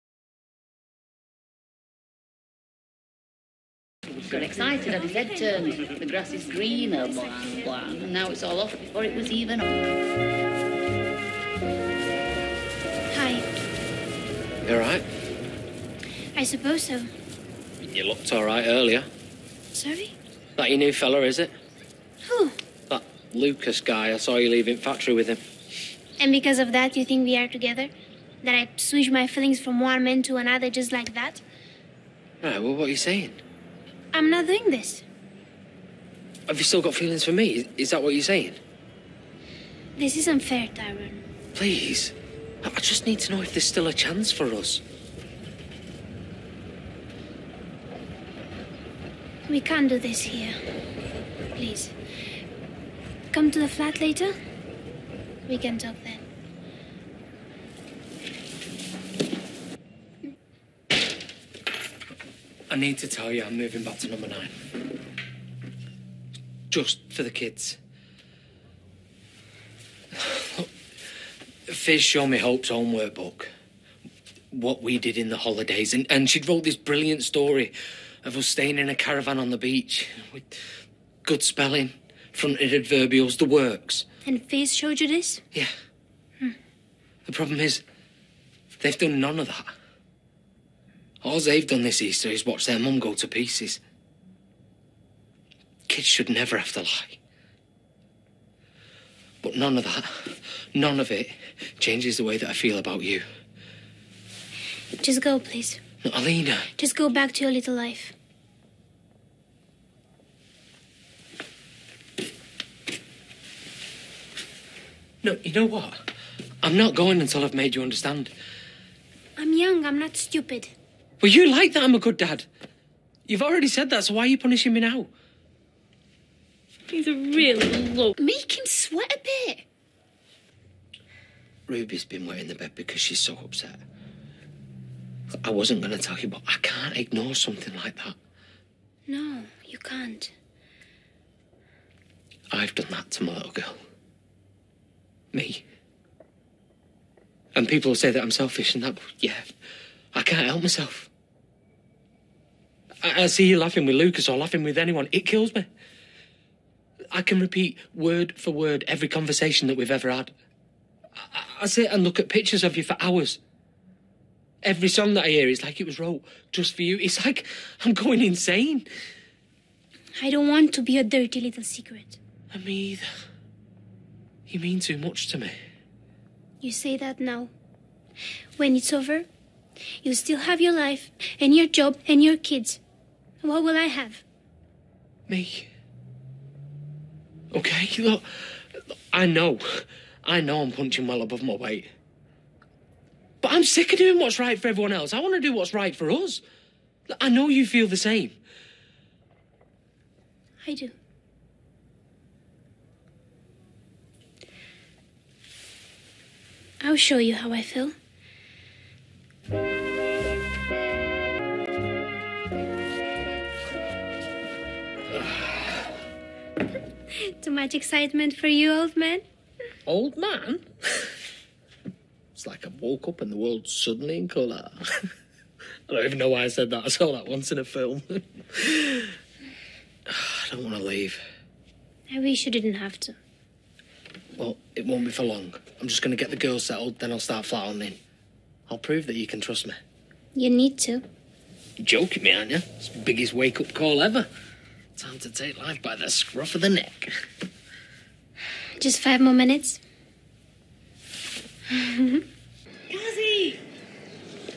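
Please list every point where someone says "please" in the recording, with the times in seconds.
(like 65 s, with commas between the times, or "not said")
41 s, 51 s, 105 s.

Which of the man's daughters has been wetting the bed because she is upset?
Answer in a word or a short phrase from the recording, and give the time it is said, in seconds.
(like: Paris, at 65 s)
Ruby, at 131 s.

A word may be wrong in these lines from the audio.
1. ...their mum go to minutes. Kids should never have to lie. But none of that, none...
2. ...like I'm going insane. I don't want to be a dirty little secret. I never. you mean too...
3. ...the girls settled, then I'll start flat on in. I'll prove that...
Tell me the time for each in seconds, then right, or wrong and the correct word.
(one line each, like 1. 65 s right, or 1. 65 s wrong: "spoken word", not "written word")
1. 92 s wrong: "pieces", not "minutes"
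2. 167 s wrong: "either", not "never"
3. 236 s right.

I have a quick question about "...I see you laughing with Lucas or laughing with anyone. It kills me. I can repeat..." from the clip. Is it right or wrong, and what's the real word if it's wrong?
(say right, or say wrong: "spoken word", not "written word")
right.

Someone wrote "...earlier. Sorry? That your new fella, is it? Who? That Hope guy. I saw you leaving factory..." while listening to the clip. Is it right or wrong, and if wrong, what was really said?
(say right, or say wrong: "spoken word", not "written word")
wrong: "Lucas", not "Hope".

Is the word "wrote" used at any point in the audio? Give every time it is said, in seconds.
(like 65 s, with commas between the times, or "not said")
76 s, 165 s.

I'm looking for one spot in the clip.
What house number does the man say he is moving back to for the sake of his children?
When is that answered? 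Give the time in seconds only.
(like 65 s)
64 s.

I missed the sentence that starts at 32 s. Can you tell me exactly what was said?
Right, well, what are you saying?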